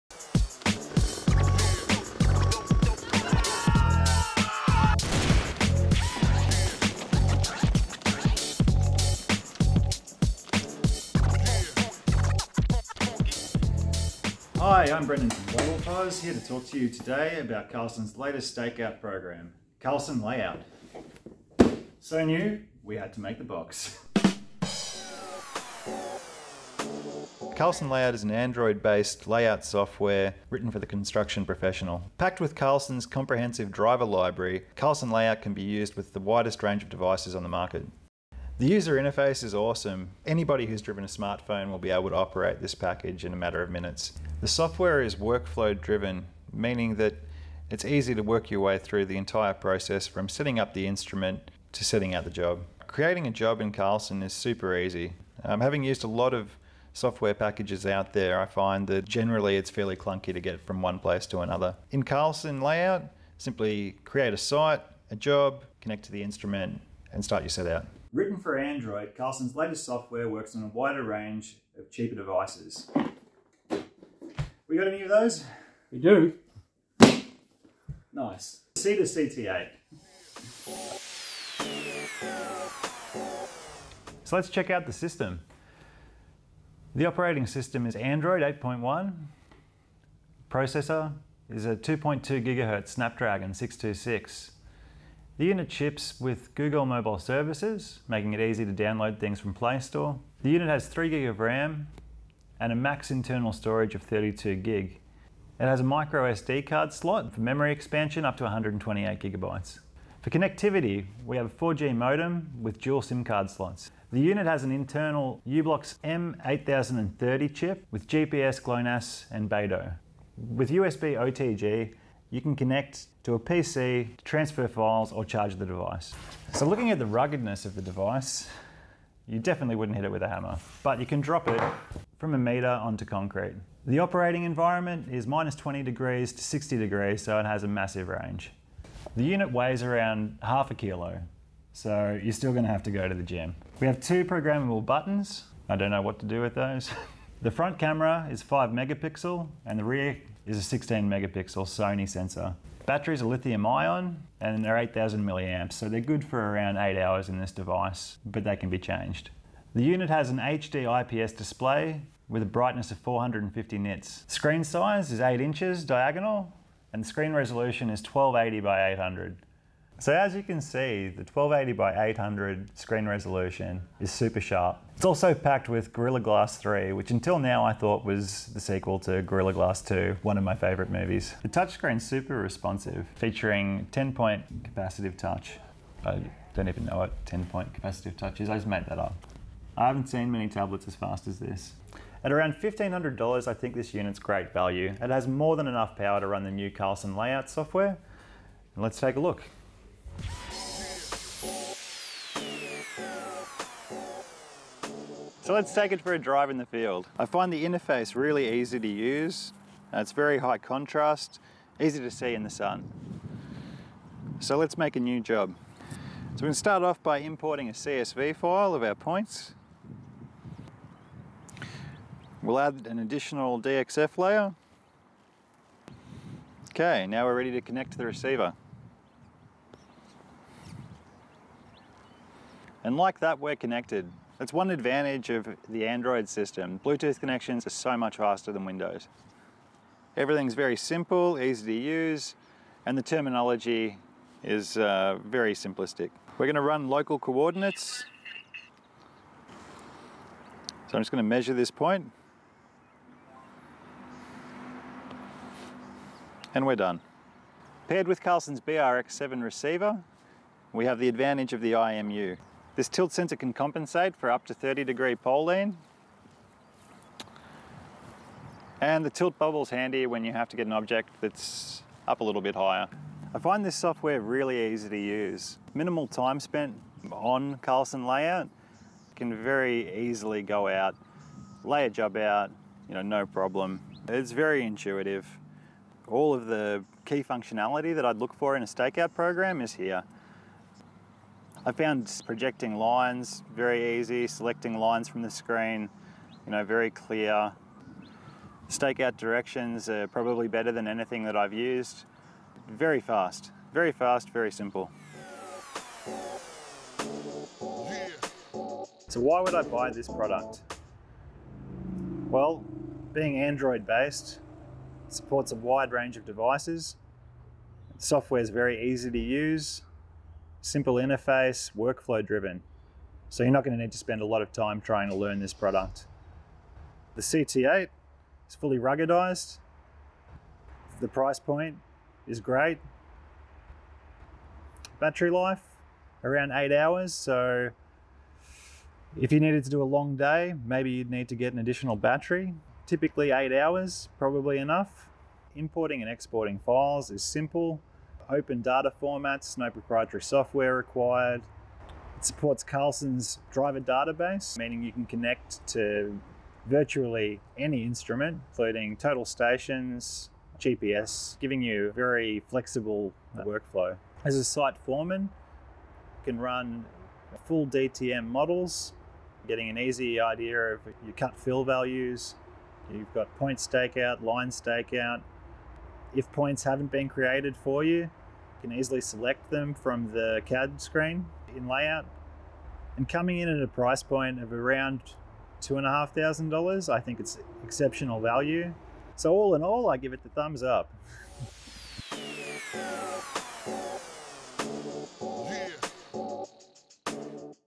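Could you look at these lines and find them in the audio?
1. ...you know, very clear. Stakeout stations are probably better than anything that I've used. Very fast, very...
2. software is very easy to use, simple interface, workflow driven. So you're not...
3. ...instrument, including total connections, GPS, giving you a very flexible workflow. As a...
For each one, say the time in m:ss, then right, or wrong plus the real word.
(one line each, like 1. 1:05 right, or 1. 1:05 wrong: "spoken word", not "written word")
1. 4:56 wrong: "directions", not "stations"
2. 5:17 right
3. 5:57 wrong: "stations", not "connections".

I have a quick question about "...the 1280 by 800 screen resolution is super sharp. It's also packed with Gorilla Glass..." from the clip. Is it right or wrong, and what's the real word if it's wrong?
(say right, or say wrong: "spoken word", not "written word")
right.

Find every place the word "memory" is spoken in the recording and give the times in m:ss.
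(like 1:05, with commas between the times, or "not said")
1:47.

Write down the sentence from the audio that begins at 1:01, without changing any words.
In Carlson layout, simply create a site, a job, connect to the instrument, and start your set out.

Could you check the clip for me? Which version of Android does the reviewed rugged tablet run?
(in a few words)
8.1.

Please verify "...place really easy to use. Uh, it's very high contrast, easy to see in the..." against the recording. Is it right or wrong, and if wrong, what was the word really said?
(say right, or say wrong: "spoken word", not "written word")
wrong: "interface", not "place".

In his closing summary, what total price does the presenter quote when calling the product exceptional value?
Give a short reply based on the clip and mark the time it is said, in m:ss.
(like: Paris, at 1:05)
$2,500, at 6:25.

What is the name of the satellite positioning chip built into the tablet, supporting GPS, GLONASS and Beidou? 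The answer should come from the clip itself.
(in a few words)
uBlox M8030.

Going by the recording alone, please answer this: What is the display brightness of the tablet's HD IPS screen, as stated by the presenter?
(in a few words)
450 nits.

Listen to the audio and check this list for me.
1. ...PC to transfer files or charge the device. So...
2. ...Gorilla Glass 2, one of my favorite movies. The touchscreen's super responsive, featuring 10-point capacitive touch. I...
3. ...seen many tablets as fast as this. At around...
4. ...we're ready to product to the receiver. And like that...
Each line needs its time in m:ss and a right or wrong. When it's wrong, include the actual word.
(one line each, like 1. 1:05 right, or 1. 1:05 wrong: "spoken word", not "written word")
1. 2:03 right
2. 2:59 right
3. 3:10 right
4. 3:47 wrong: "connect", not "product".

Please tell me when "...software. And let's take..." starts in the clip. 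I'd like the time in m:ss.
3:17.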